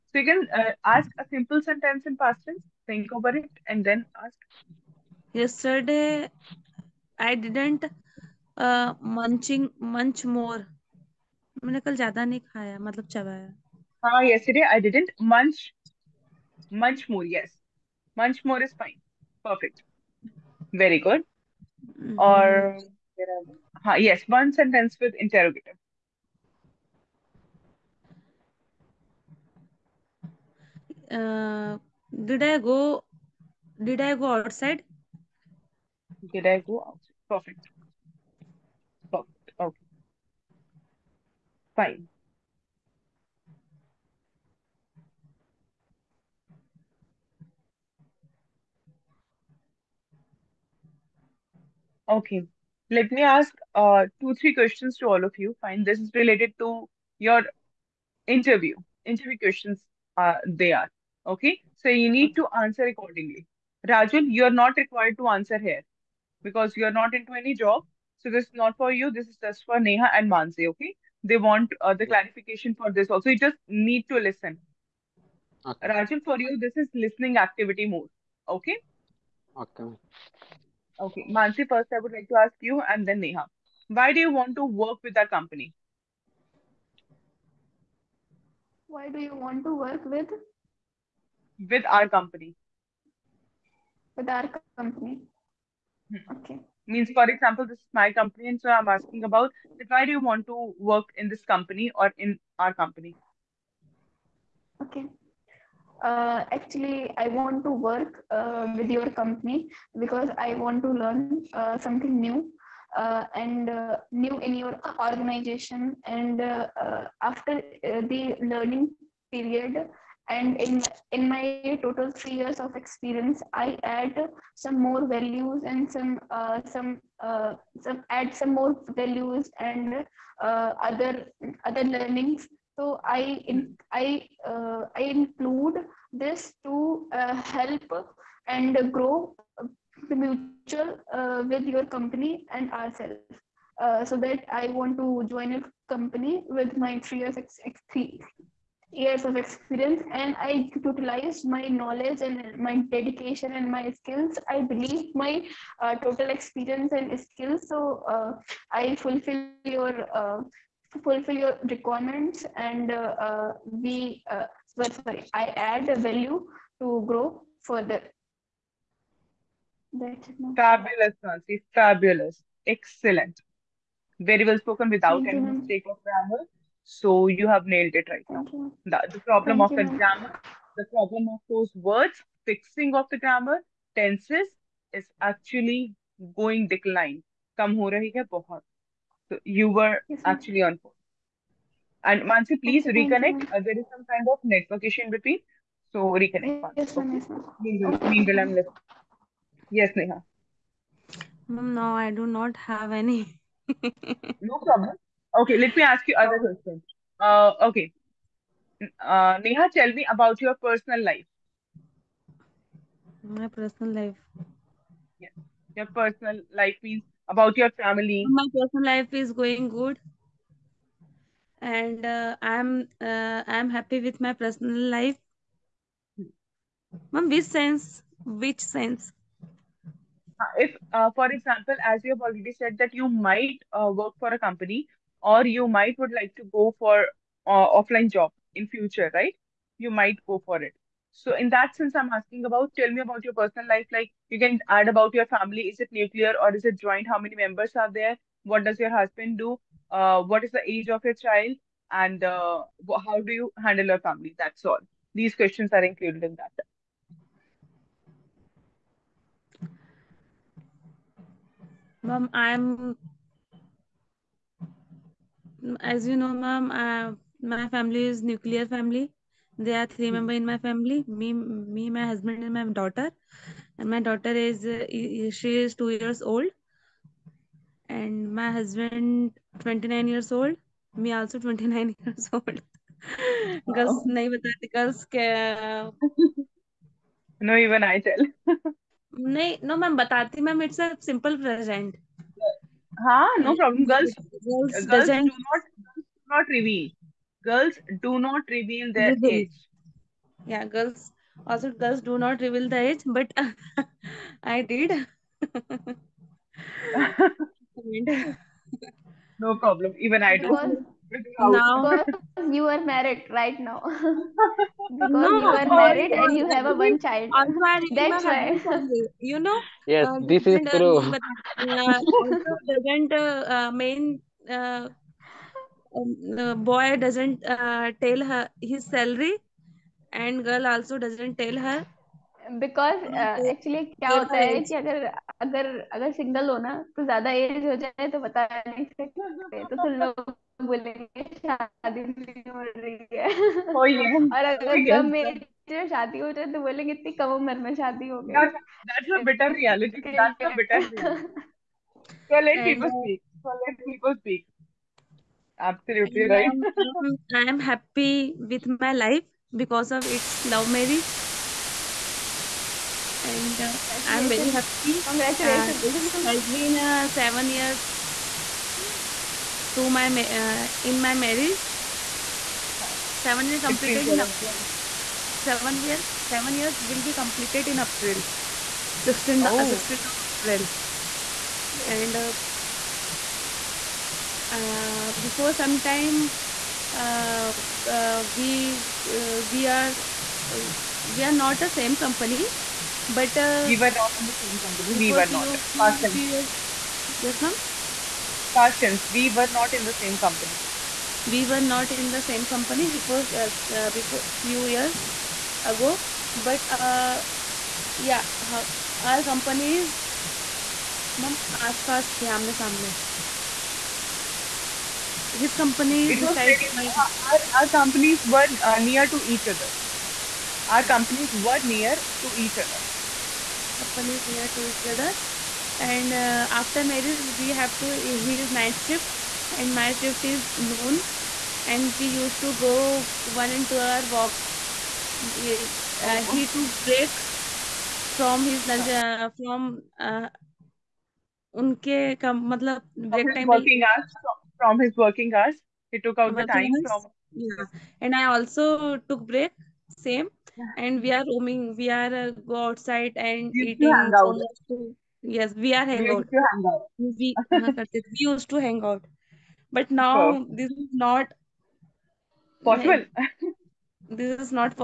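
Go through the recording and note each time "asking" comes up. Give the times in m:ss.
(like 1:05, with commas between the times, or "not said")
1:38, 4:02.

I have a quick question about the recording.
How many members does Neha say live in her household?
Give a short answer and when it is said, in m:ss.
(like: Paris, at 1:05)
3, at 4:29.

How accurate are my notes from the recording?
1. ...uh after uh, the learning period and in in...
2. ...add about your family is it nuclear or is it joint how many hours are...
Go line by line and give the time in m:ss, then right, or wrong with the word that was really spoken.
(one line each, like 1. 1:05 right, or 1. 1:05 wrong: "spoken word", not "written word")
1. 1:56 right
2. 4:04 wrong: "members", not "hours".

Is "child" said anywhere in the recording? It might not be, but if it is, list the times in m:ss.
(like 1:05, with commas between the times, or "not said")
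4:11, 5:16.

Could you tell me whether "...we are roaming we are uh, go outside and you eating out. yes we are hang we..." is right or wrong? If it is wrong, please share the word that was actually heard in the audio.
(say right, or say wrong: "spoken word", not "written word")
right.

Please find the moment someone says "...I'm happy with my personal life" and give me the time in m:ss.
3:43.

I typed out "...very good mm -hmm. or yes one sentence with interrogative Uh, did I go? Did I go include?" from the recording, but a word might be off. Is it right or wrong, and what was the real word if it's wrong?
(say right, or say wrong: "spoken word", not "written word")
wrong: "outside", not "include".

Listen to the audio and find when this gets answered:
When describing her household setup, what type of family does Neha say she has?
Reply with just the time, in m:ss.
4:27.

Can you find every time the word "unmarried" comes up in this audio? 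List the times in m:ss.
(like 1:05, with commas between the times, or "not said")
5:17.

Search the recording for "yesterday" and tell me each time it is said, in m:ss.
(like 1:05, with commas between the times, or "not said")
0:05, 0:14.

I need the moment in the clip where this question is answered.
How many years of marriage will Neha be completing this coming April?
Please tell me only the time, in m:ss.
6:16.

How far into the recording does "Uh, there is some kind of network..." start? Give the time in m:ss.
3:13.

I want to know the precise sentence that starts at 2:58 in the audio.
The, the, problem Thank of you, the grammar, the problem of those words, fixing of the grammar, tenses is actually going decline.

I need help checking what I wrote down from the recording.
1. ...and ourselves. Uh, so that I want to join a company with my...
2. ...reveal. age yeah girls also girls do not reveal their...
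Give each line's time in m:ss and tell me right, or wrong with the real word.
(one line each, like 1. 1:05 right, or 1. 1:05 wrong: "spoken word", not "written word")
1. 2:22 right
2. 4:59 right.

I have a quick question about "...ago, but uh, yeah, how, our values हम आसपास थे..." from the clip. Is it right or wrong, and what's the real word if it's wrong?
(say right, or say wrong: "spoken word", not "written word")
wrong: "companies", not "values".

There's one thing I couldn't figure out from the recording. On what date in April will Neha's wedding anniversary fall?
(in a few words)
16th April.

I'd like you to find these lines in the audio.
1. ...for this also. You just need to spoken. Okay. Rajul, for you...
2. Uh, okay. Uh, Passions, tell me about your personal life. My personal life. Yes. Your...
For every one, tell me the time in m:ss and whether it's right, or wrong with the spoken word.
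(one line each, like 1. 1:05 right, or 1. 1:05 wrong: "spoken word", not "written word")
1. 1:12 wrong: "listen", not "spoken"
2. 3:27 wrong: "Neha", not "Passions".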